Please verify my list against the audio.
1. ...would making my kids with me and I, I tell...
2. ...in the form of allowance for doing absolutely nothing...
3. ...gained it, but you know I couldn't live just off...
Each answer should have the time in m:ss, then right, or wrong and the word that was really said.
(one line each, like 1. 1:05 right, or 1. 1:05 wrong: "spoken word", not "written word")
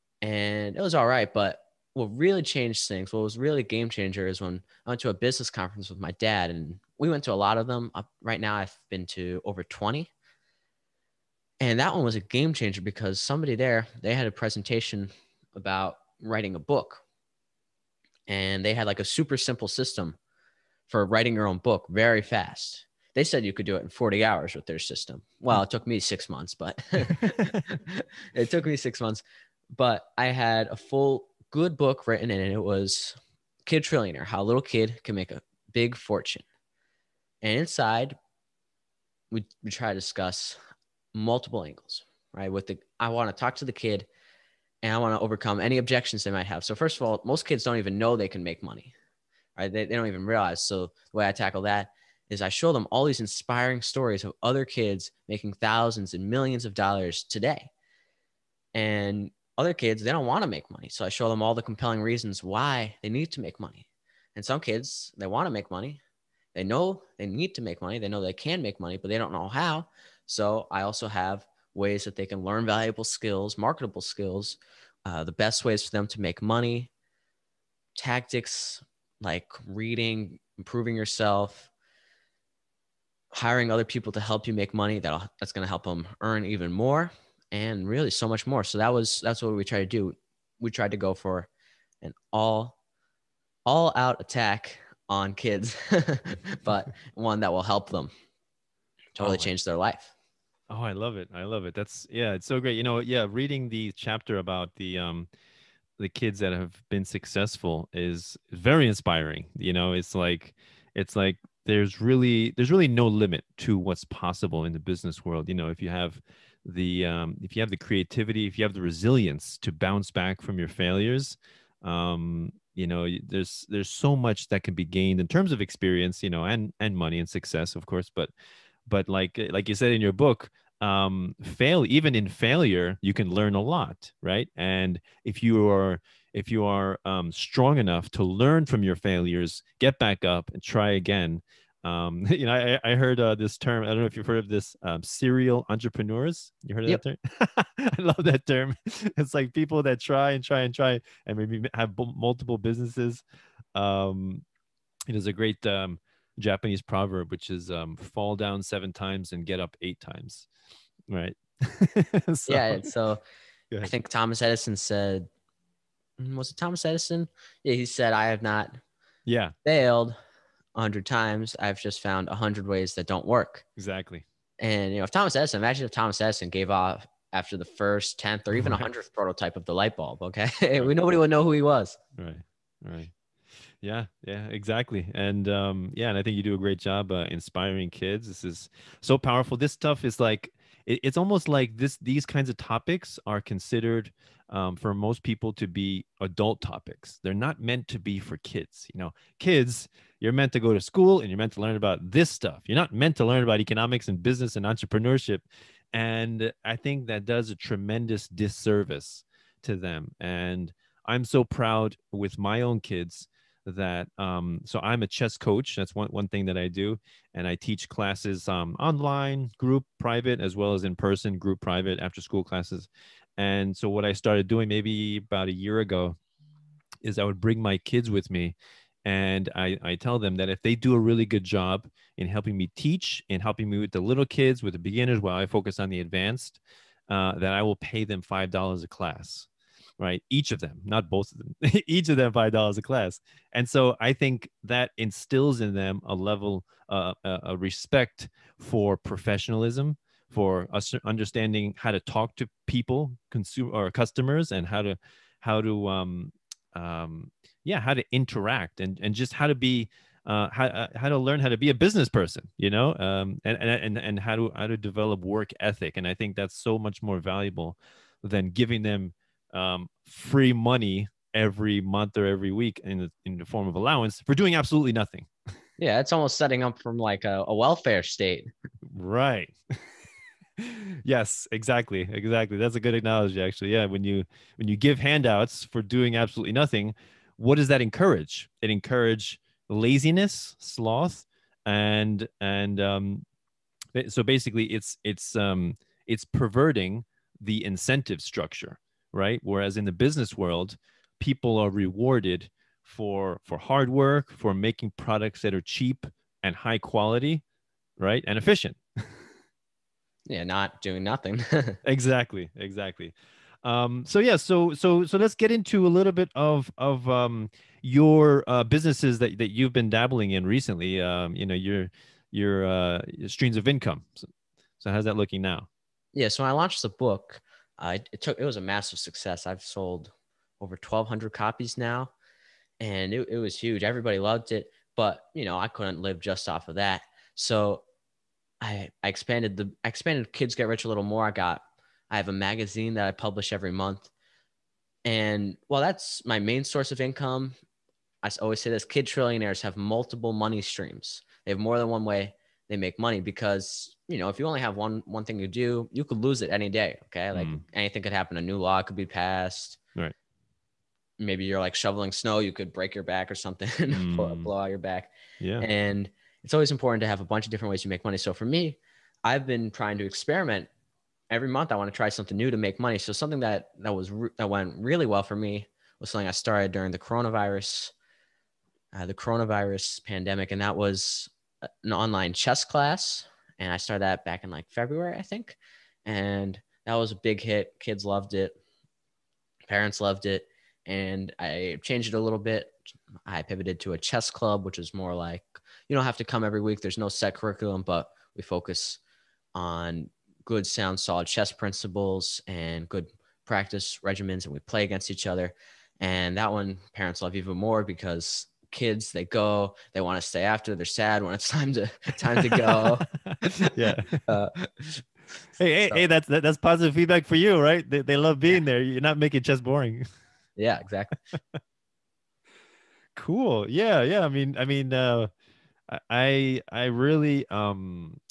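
1. 3:47 wrong: "bring", not "making"
2. 4:33 right
3. 5:34 wrong: "loved", not "gained".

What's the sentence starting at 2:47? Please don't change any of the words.
Yeah, he said, I have not yeah.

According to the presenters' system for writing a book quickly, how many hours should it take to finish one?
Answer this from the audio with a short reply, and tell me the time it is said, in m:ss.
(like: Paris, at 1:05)
40, at 0:23.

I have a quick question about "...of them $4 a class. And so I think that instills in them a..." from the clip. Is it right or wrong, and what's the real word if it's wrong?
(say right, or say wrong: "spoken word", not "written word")
wrong: "5", not "4".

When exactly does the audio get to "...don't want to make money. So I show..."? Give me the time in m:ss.
1:00.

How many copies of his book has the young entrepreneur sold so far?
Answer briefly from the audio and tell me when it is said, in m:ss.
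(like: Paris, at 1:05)
over 1,200, at 5:30.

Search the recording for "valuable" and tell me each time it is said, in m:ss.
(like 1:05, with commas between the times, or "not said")
1:12, 4:27.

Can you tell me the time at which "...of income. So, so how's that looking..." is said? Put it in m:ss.
5:23.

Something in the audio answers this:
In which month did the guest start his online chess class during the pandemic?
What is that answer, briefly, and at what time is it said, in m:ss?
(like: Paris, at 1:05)
February, at 6:24.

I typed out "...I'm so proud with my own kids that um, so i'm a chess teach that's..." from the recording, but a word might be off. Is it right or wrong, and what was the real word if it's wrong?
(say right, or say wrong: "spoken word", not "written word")
wrong: "coach", not "teach".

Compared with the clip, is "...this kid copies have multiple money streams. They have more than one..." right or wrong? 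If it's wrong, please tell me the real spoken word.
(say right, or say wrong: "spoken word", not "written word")
wrong: "trillionaires", not "copies".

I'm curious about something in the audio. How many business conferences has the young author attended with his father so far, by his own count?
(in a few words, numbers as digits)
over 20.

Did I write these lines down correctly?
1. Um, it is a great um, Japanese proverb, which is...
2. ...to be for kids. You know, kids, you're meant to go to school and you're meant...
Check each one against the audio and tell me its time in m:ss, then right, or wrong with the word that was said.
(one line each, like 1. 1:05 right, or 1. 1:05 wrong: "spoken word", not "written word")
1. 2:33 right
2. 3:17 right.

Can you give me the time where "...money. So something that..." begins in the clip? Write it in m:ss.
6:12.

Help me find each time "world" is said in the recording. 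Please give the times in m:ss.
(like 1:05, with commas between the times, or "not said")
1:55, 5:00.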